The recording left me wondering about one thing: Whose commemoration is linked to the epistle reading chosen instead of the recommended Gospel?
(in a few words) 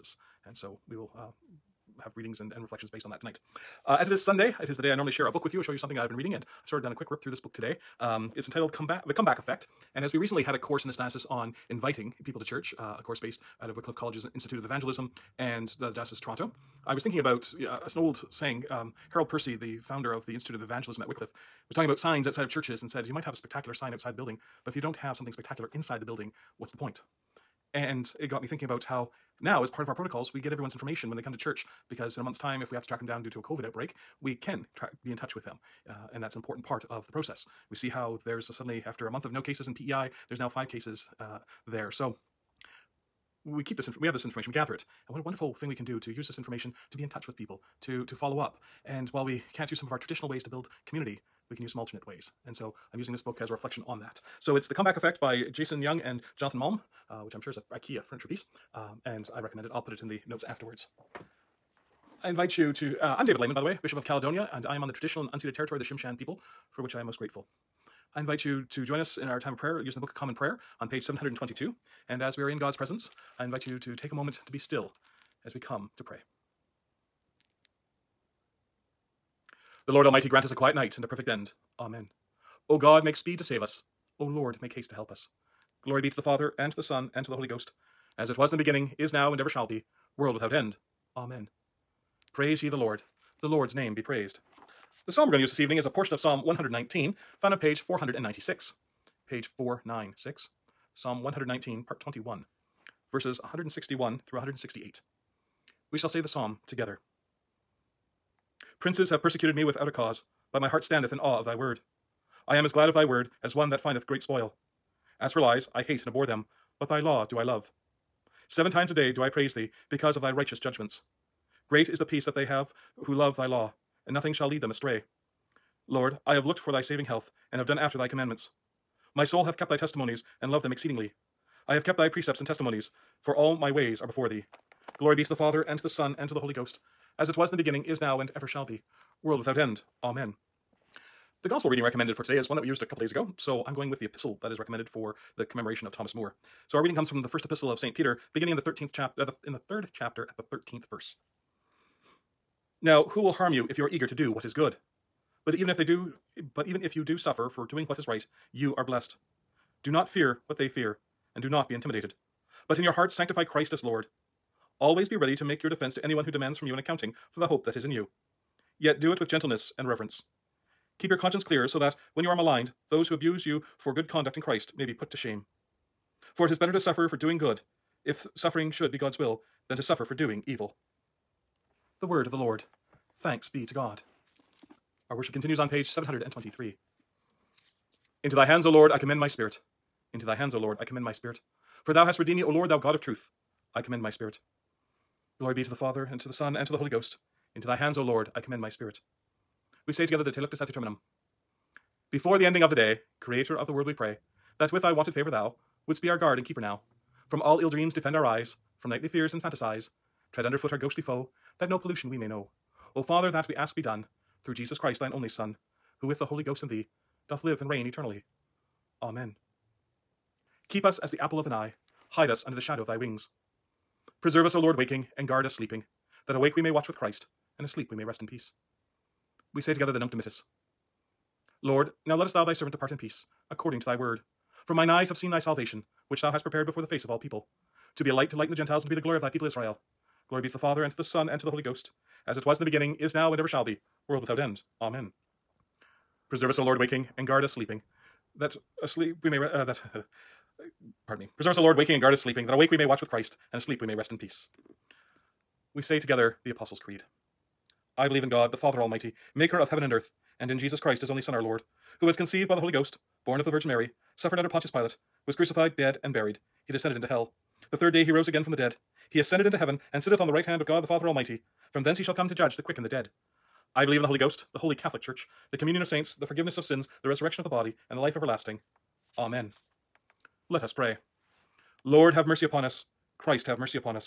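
Thomas More.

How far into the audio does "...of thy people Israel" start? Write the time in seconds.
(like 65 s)
239 s.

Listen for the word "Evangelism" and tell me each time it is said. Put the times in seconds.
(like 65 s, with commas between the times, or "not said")
14 s, 20 s.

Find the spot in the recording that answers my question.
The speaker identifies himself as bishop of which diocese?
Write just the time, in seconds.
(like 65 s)
64 s.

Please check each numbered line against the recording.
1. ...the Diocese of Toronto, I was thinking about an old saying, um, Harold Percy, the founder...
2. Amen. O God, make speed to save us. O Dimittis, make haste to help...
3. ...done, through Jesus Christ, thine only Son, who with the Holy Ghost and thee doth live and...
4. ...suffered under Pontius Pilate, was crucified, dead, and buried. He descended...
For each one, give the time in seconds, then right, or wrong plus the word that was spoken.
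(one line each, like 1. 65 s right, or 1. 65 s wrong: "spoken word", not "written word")
1. 15 s right
2. 81 s wrong: "Lord", not "Dimittis"
3. 213 s right
4. 264 s right.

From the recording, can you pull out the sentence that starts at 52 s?
And so I'm using this book as a reflection on that.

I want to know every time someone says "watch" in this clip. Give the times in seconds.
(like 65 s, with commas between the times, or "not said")
226 s, 252 s.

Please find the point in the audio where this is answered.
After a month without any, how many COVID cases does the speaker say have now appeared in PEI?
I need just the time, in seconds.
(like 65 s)
40 s.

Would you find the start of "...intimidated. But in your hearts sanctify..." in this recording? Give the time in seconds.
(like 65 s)
161 s.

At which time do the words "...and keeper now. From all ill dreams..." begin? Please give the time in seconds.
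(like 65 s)
206 s.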